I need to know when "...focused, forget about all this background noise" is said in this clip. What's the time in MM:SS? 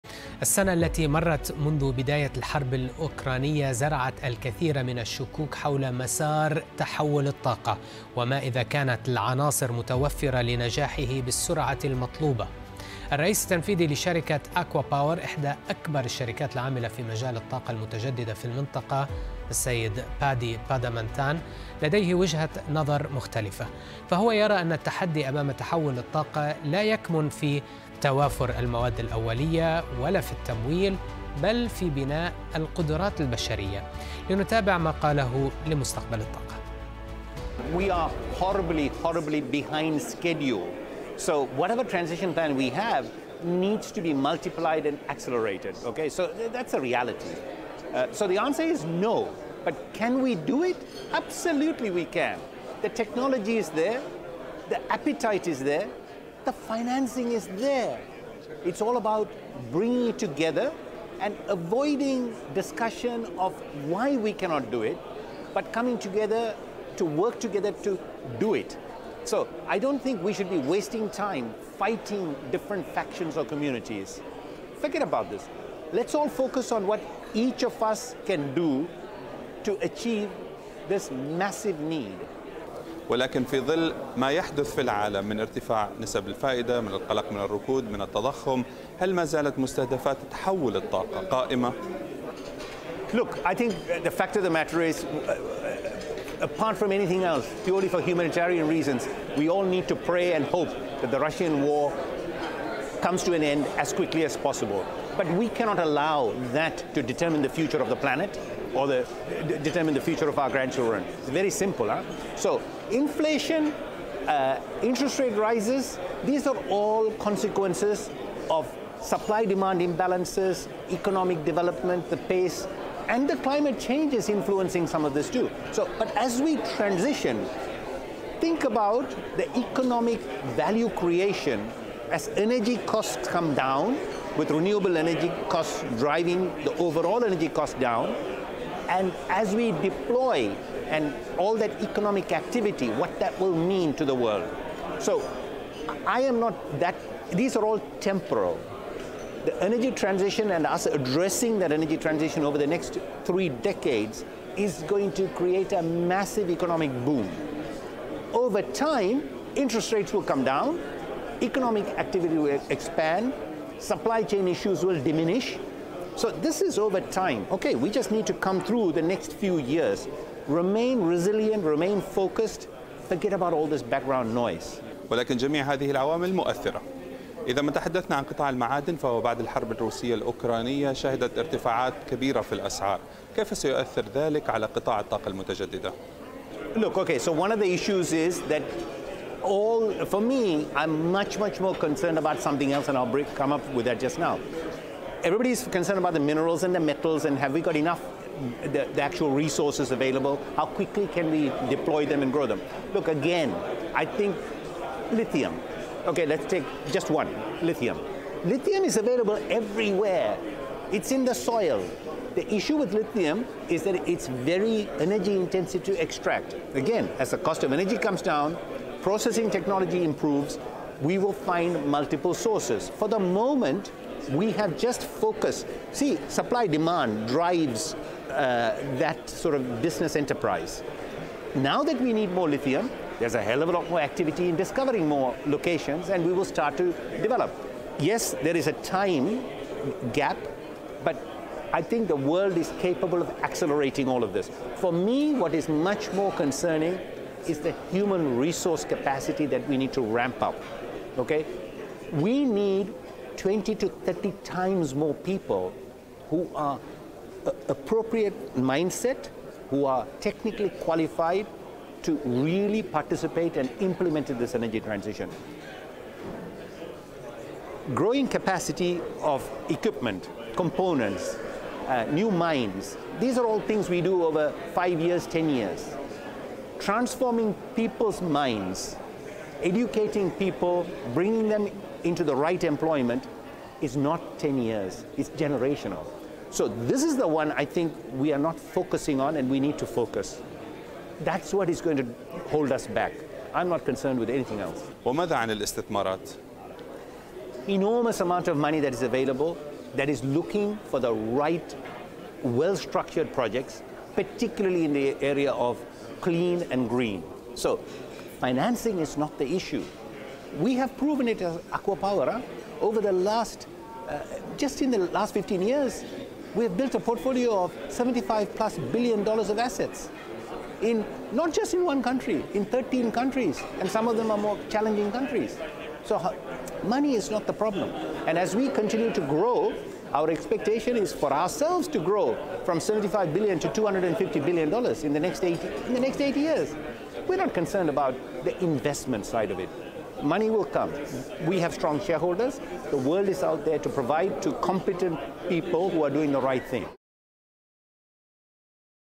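02:52.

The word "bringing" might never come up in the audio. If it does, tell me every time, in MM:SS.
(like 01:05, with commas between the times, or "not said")
00:59, 04:41.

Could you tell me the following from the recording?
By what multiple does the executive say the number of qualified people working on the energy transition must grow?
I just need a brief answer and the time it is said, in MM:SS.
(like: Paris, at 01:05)
20 to 30 times, at 04:13.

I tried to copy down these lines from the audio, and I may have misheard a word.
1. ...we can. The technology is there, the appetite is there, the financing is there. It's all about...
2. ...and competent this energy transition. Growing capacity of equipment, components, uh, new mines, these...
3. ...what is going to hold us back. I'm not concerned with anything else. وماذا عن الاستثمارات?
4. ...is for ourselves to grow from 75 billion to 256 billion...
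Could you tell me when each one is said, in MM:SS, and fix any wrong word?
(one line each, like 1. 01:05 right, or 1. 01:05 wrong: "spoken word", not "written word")
1. 00:51 right
2. 04:23 wrong: "implement", not "competent"
3. 04:51 right
4. 05:30 wrong: "250", not "256".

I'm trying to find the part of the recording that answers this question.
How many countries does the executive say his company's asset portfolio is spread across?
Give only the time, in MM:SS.
05:22.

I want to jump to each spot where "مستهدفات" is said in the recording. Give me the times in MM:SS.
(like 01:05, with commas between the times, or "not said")
01:29.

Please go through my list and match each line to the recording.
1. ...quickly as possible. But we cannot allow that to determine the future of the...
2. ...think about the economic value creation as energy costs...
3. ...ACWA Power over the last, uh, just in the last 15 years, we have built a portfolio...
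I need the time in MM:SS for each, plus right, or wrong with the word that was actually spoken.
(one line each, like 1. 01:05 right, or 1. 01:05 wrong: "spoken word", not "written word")
1. 01:43 right
2. 02:08 right
3. 05:11 right.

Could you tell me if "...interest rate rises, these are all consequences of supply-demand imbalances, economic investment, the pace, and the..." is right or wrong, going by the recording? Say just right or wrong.
wrong.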